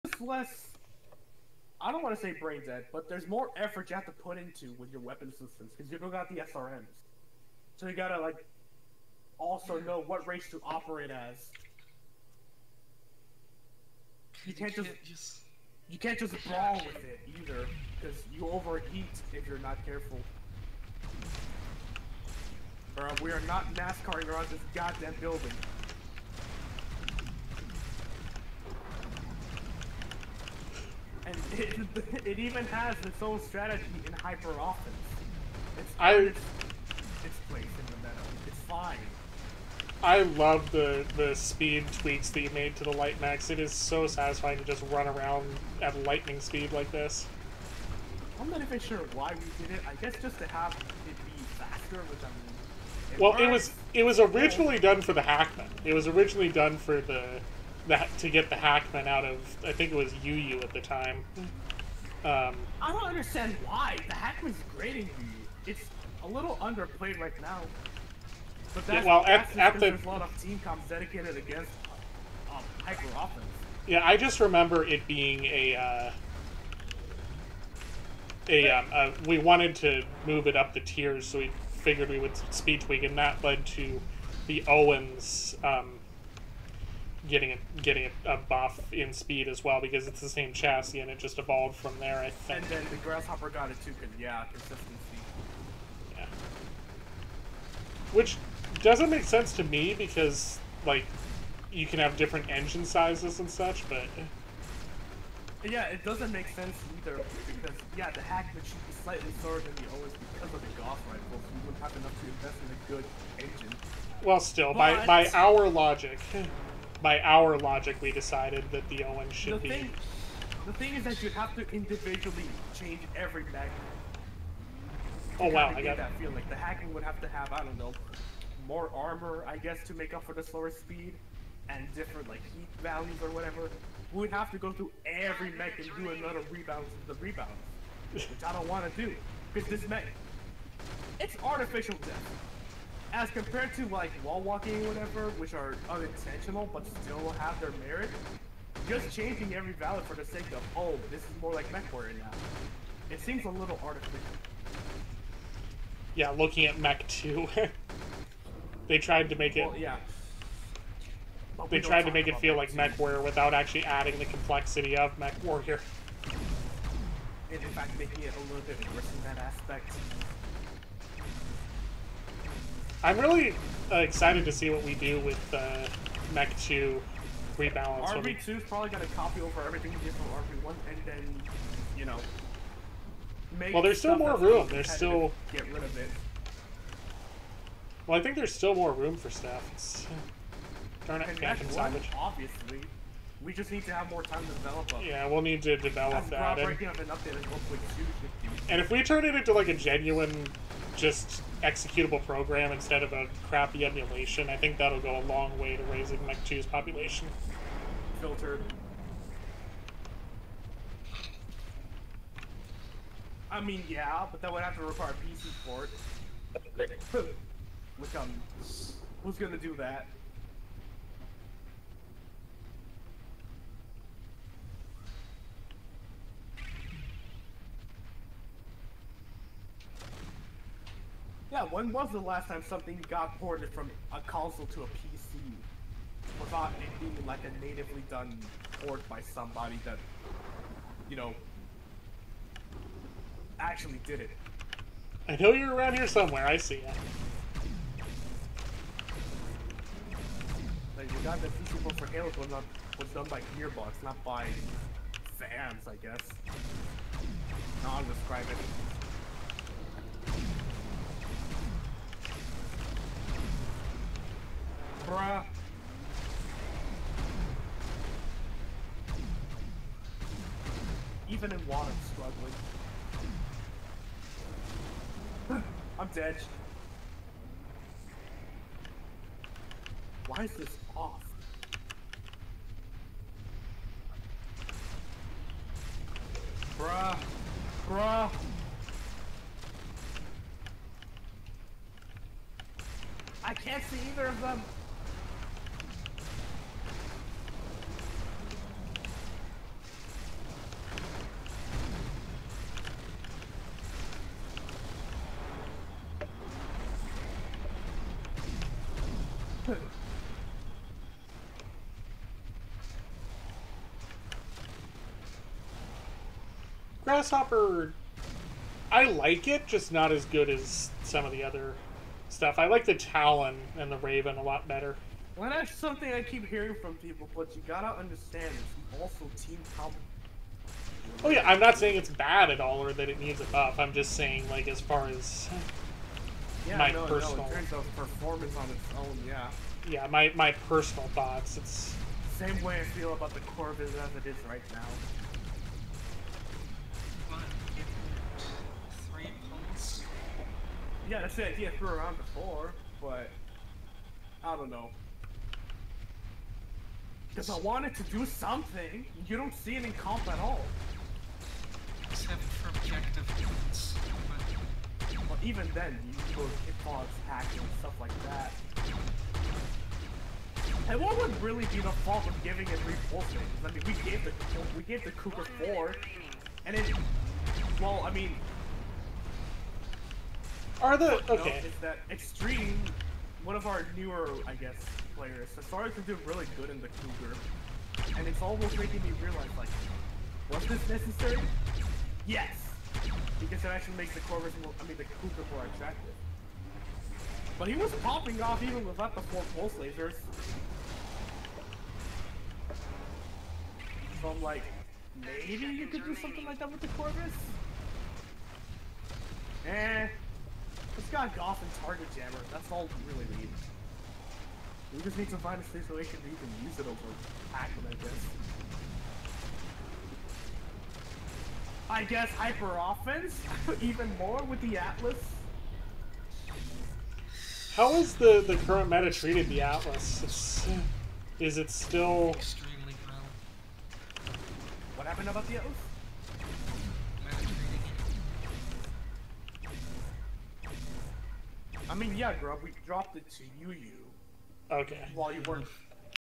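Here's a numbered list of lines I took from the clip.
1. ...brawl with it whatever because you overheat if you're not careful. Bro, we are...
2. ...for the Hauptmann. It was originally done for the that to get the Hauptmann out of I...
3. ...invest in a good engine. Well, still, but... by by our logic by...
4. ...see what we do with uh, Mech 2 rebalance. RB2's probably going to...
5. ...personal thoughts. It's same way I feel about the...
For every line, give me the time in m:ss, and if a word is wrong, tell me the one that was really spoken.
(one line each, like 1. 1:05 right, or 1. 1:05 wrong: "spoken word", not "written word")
1. 0:16 wrong: "either", not "whatever"
2. 0:55 right
3. 1:52 right
4. 2:54 right
5. 5:40 right.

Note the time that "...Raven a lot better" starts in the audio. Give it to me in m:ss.
5:23.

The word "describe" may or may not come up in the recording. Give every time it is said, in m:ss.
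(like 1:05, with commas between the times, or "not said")
4:18.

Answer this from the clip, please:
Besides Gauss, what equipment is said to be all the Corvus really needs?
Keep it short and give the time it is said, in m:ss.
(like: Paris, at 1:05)
Target Jammer, at 6:51.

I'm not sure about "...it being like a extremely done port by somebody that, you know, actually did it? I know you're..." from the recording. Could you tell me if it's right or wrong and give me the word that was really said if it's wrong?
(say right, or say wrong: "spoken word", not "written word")
wrong: "natively", not "extremely".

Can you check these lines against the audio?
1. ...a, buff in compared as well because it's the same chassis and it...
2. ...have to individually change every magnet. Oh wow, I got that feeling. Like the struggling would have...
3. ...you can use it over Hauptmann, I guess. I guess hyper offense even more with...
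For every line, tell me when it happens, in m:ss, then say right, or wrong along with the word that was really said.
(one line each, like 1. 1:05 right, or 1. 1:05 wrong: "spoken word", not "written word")
1. 1:28 wrong: "speed", not "compared"
2. 2:01 wrong: "hacking", not "struggling"
3. 6:56 right.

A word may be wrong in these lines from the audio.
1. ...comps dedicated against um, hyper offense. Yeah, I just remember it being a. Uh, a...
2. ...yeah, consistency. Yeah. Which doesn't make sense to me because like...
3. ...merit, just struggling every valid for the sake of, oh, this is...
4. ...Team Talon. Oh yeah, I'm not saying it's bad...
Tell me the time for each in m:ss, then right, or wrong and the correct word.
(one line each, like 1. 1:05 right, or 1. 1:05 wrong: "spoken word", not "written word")
1. 1:10 right
2. 1:34 right
3. 2:27 wrong: "changing", not "struggling"
4. 5:29 right.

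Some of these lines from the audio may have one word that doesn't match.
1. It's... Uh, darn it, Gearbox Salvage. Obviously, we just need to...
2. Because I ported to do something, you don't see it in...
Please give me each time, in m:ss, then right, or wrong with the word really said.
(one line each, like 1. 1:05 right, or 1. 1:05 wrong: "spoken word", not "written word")
1. 3:09 wrong: "Phantom", not "Gearbox"
2. 5:57 wrong: "wanted", not "ported".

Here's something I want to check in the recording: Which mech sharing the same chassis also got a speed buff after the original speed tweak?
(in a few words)
Owens.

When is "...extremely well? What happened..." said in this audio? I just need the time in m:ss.
7:12.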